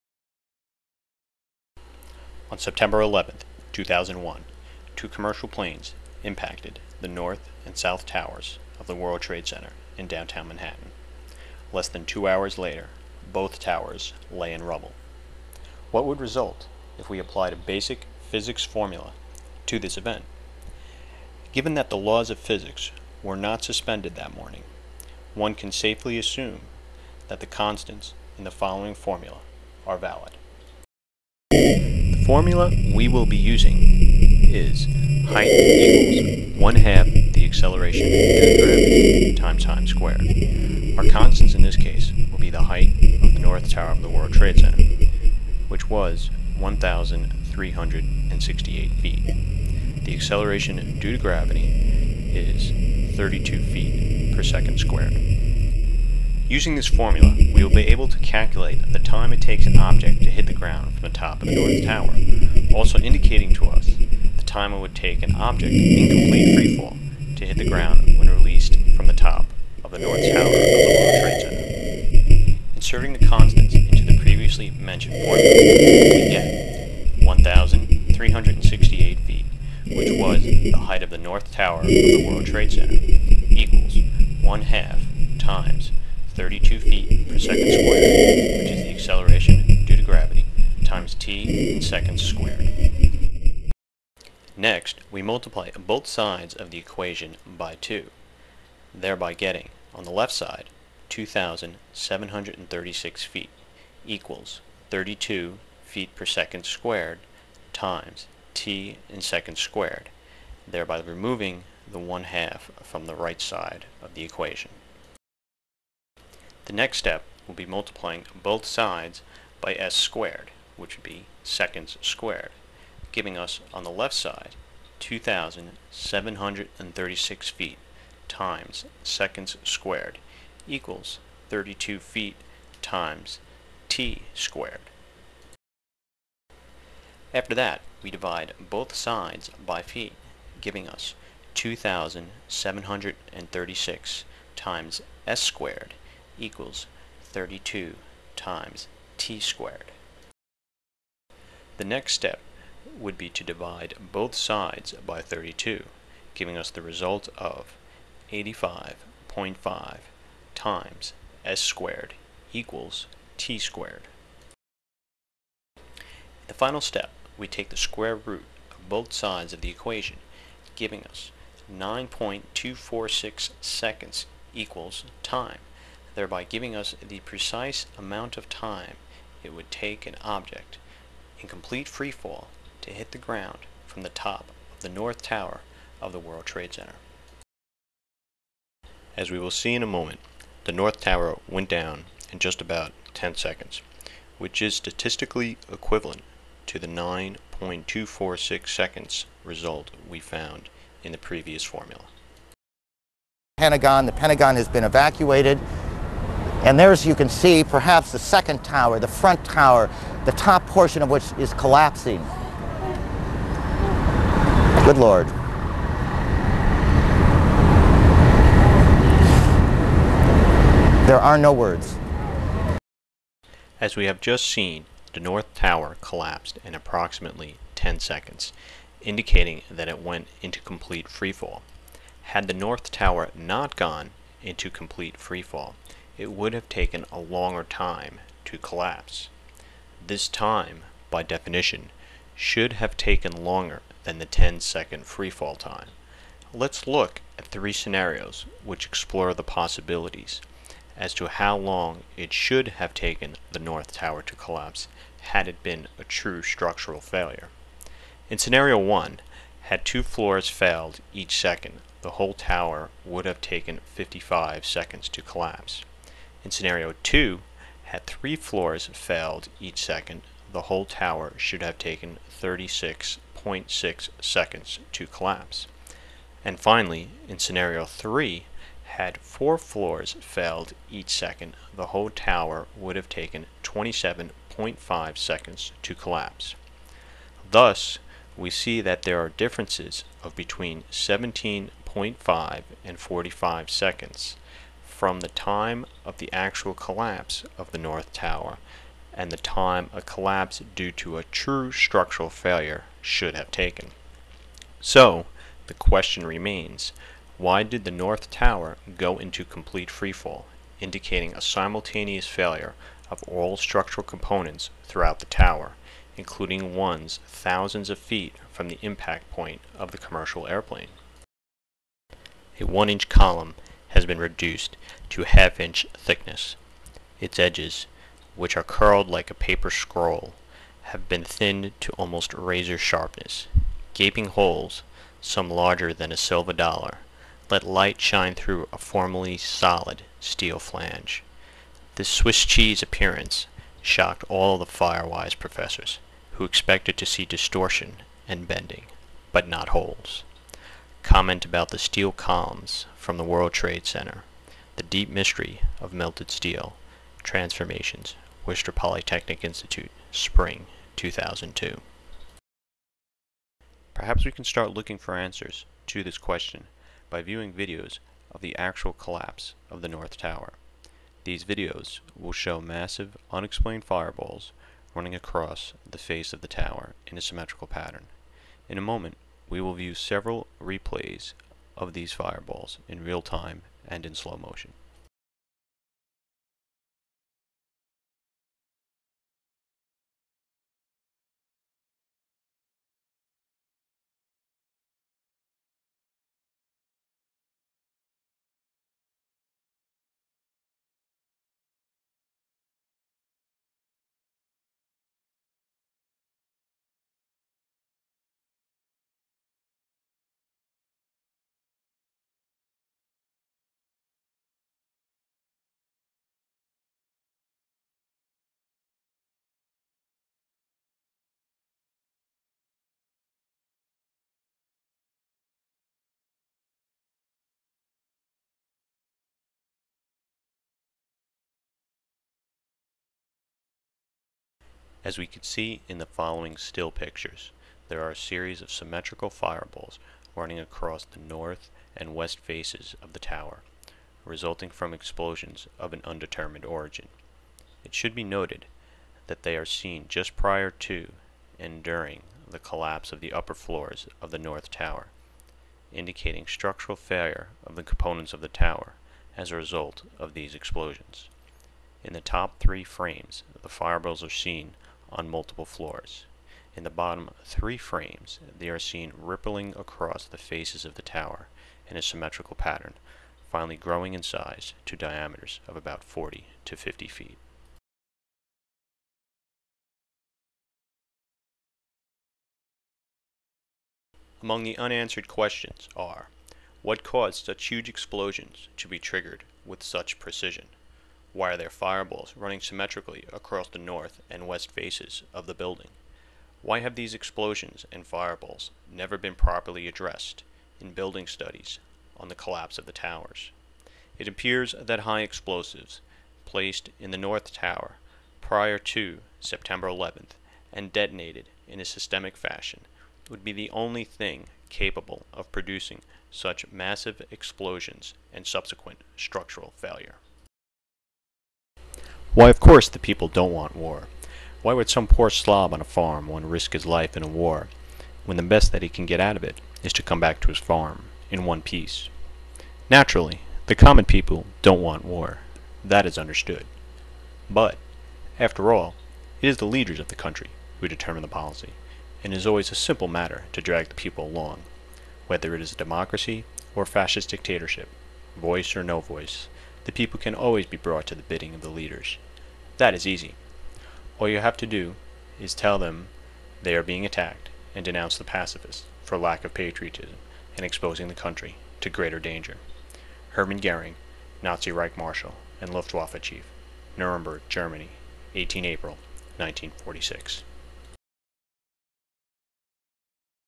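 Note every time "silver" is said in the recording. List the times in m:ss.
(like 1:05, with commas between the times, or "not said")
5:36.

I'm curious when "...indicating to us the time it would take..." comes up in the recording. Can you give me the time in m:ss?
1:02.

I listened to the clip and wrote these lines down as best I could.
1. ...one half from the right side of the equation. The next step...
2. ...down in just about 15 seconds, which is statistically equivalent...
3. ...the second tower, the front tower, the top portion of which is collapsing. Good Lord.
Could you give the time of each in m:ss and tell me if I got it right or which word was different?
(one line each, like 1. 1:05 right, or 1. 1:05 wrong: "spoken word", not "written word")
1. 1:51 right
2. 3:11 wrong: "10", not "15"
3. 3:28 right.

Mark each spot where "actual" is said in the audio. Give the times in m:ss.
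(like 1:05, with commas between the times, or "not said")
4:56, 6:08.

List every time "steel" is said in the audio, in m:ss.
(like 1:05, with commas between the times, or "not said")
5:40, 5:51, 5:56.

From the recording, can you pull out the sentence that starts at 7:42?
In the top three frames, the fireballs are seen on multiple floors.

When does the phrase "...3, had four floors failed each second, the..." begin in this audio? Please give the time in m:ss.
4:37.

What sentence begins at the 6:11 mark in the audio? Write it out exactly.
These videos will show massive, unexplained fireballs running across the face of the tower in a symmetrical pattern.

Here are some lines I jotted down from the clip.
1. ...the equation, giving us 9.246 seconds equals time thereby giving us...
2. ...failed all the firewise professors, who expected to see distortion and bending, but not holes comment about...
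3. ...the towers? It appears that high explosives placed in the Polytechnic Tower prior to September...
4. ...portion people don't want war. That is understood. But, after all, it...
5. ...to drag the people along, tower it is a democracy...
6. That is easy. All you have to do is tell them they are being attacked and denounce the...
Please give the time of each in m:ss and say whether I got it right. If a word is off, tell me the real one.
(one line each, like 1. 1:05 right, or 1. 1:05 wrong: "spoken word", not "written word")
1. 2:49 right
2. 5:43 wrong: "shocked", not "failed"
3. 8:22 wrong: "North", not "Polytechnic"
4. 8:53 wrong: "common", not "portion"
5. 9:03 wrong: "whether", not "tower"
6. 9:12 right.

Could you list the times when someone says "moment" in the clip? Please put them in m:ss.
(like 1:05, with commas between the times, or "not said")
3:09, 6:18.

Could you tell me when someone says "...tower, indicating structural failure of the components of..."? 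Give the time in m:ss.
7:34.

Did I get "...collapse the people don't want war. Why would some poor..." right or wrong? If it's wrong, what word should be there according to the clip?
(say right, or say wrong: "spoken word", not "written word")
wrong: "course", not "collapse".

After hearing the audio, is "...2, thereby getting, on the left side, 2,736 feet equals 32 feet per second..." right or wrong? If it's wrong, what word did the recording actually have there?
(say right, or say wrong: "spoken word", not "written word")
right.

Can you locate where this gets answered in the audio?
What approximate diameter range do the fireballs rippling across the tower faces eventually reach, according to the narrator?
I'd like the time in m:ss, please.
7:56.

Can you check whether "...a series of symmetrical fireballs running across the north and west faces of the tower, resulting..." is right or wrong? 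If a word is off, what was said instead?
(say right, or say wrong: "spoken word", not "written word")
right.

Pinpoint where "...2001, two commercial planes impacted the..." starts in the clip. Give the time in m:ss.
0:03.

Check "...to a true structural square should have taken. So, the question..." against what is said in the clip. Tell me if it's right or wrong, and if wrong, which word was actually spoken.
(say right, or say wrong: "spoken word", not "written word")
wrong: "failure", not "square".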